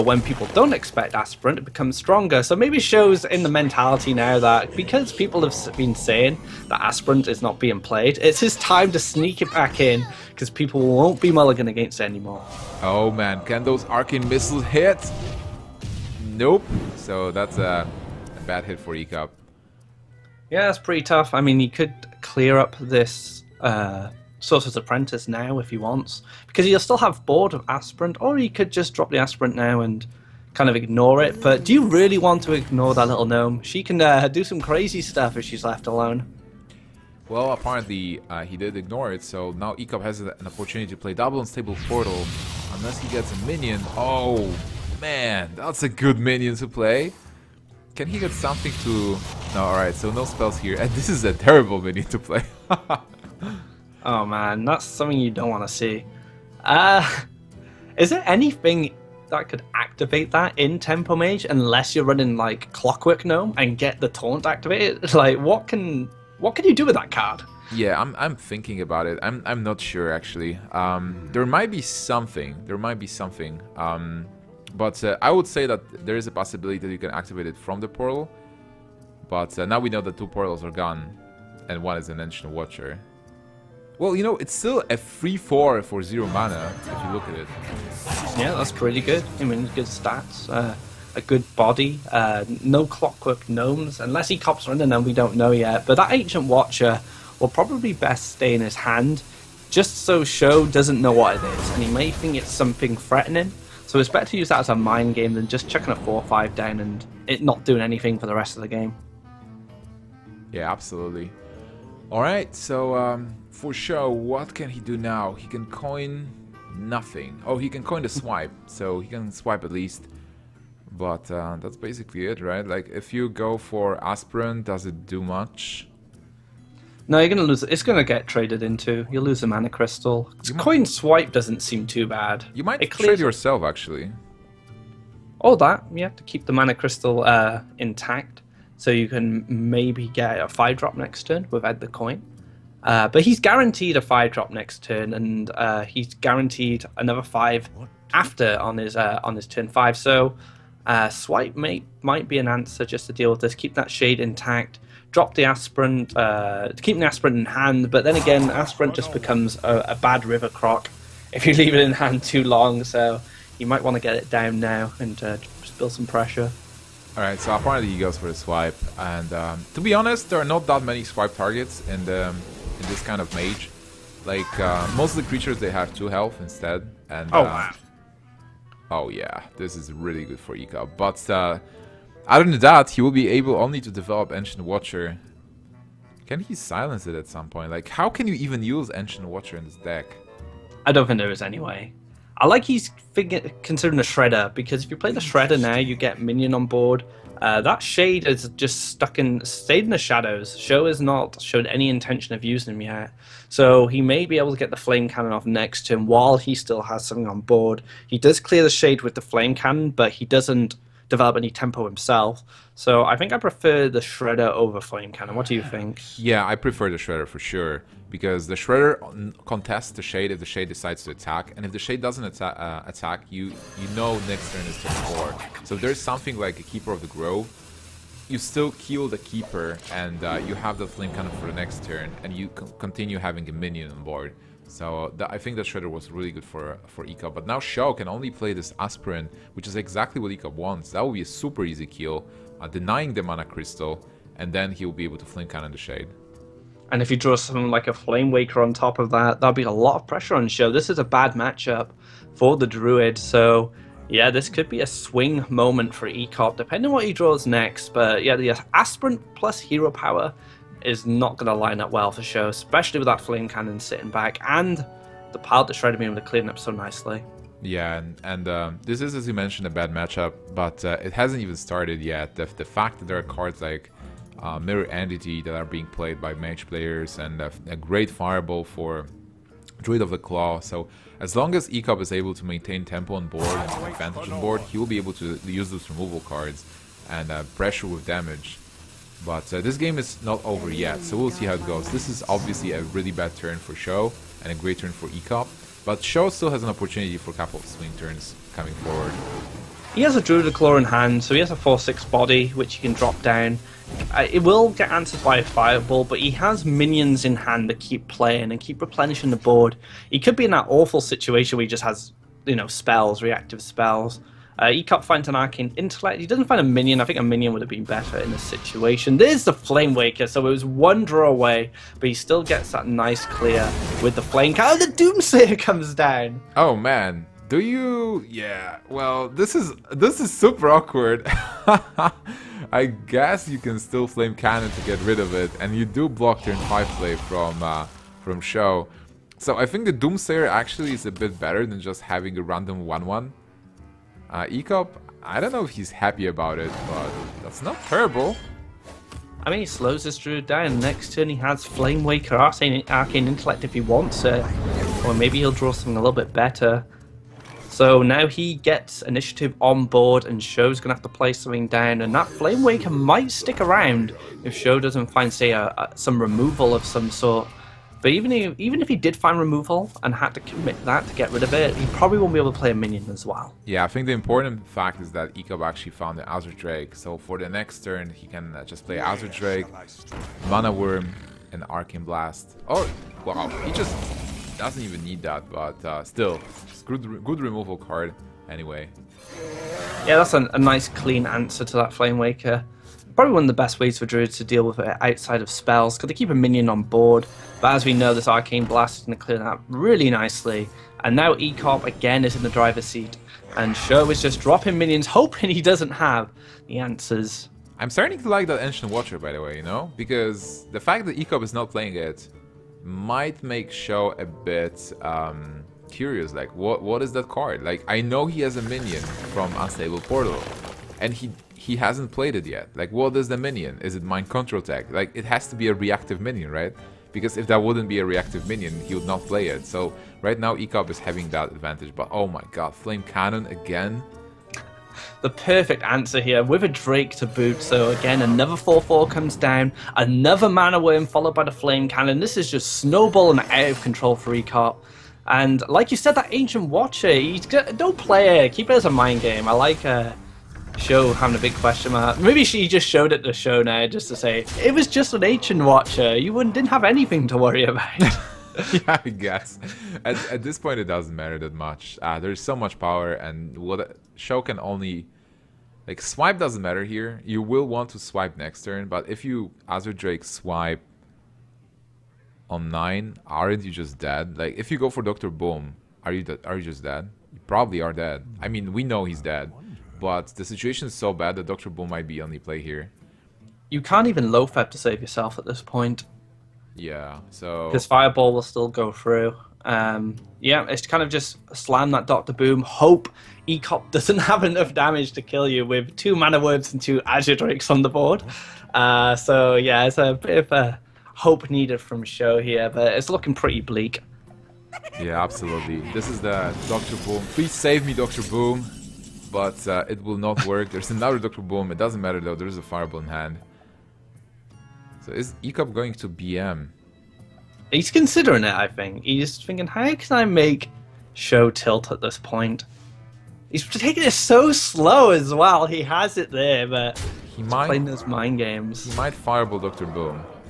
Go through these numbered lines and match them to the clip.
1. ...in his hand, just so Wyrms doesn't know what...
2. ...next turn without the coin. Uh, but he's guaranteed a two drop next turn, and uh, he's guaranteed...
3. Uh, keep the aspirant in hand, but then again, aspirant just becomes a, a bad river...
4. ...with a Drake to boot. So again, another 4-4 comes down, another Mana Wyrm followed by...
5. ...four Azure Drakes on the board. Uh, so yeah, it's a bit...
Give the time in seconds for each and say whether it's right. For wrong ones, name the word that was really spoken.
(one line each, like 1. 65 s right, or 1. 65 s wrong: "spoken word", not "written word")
1. 98 s wrong: "SjoW", not "Wyrms"
2. 140 s wrong: "five", not "two"
3. 156 s right
4. 436 s right
5. 496 s wrong: "two", not "four".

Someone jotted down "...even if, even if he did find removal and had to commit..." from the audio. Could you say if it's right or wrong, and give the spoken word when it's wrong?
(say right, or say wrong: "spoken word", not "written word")
right.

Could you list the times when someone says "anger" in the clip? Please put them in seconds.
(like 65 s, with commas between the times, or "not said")
not said.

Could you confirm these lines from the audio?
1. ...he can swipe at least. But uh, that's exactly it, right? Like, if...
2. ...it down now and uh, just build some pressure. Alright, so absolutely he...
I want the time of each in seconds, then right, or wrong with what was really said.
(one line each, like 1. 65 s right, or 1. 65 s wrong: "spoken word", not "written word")
1. 118 s wrong: "basically", not "exactly"
2. 164 s wrong: "apparently", not "absolutely".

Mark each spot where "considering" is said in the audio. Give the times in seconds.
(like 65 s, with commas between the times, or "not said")
193 s, 517 s.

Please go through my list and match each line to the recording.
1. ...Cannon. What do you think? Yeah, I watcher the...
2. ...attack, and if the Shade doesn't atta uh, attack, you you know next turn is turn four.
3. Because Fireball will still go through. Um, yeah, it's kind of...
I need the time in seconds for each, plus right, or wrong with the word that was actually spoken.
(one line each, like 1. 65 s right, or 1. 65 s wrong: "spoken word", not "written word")
1. 215 s wrong: "prefer", not "watcher"
2. 221 s right
3. 487 s right.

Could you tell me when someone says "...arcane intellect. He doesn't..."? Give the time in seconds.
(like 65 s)
315 s.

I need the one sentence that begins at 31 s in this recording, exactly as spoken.
But do you really want to ignore that little gnome?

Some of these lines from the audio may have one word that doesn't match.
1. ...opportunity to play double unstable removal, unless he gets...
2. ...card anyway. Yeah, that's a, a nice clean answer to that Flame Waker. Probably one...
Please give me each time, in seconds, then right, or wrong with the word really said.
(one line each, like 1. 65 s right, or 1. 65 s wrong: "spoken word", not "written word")
1. 40 s wrong: "portal", not "removal"
2. 387 s right.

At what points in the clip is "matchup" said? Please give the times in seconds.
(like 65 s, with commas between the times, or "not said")
251 s, 269 s.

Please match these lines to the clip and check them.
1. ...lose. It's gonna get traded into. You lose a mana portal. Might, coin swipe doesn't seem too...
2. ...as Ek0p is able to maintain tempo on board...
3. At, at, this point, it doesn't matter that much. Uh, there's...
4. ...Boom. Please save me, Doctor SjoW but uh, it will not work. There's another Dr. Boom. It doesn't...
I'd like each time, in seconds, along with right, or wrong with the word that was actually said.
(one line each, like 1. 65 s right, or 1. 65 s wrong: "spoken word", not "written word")
1. 127 s wrong: "crystal", not "portal"
2. 281 s right
3. 460 s right
4. 506 s wrong: "Boom", not "SjoW".